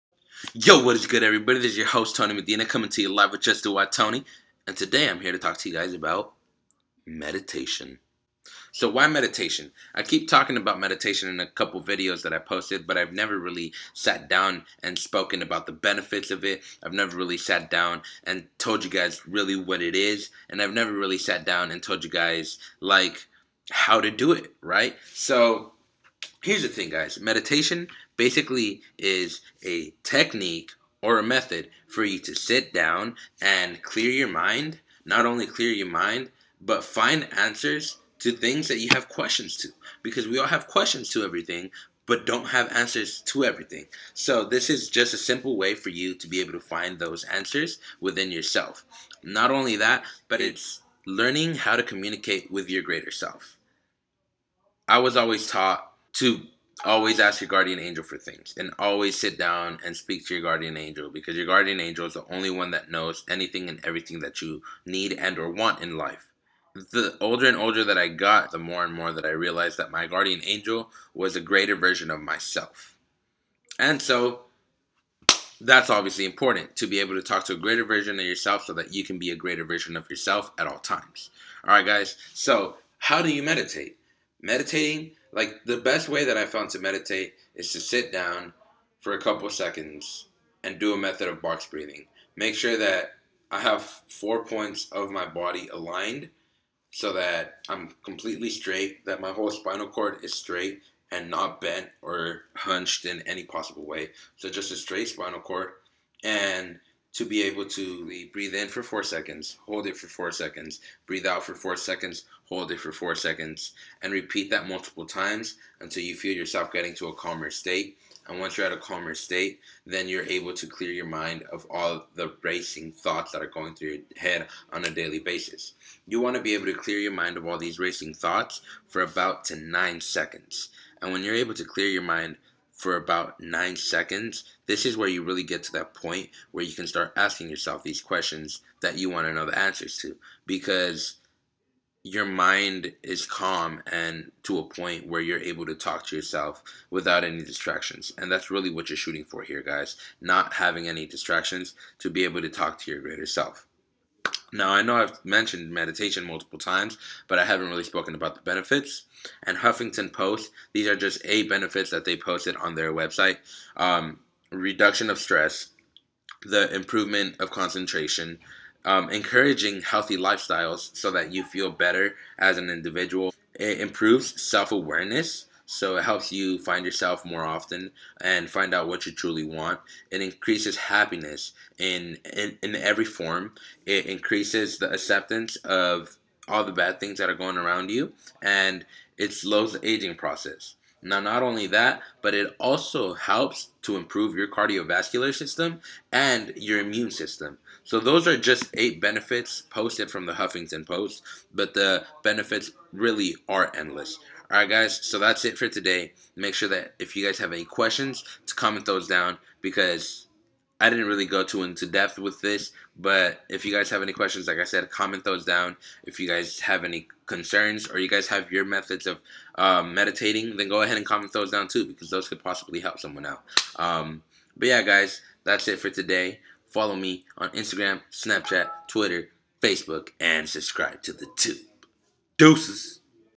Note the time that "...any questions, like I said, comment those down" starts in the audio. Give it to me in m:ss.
3:34.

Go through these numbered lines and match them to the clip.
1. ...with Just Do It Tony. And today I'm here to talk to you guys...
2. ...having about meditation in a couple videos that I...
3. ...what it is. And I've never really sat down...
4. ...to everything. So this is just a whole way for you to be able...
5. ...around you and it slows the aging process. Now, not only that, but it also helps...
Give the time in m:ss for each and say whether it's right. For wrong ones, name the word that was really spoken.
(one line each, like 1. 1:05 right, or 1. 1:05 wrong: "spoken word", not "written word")
1. 0:03 right
2. 0:10 wrong: "talking", not "having"
3. 0:19 right
4. 0:43 wrong: "simple", not "whole"
5. 3:07 right.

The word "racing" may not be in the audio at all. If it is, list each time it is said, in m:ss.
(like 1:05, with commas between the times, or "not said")
2:02, 2:07.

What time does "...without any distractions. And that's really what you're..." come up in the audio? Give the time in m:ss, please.
2:26.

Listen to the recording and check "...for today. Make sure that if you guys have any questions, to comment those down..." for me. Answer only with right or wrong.
right.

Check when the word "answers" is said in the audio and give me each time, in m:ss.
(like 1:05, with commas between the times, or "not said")
0:37, 0:42, 0:47, 2:19.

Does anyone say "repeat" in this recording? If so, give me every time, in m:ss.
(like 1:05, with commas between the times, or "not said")
1:54.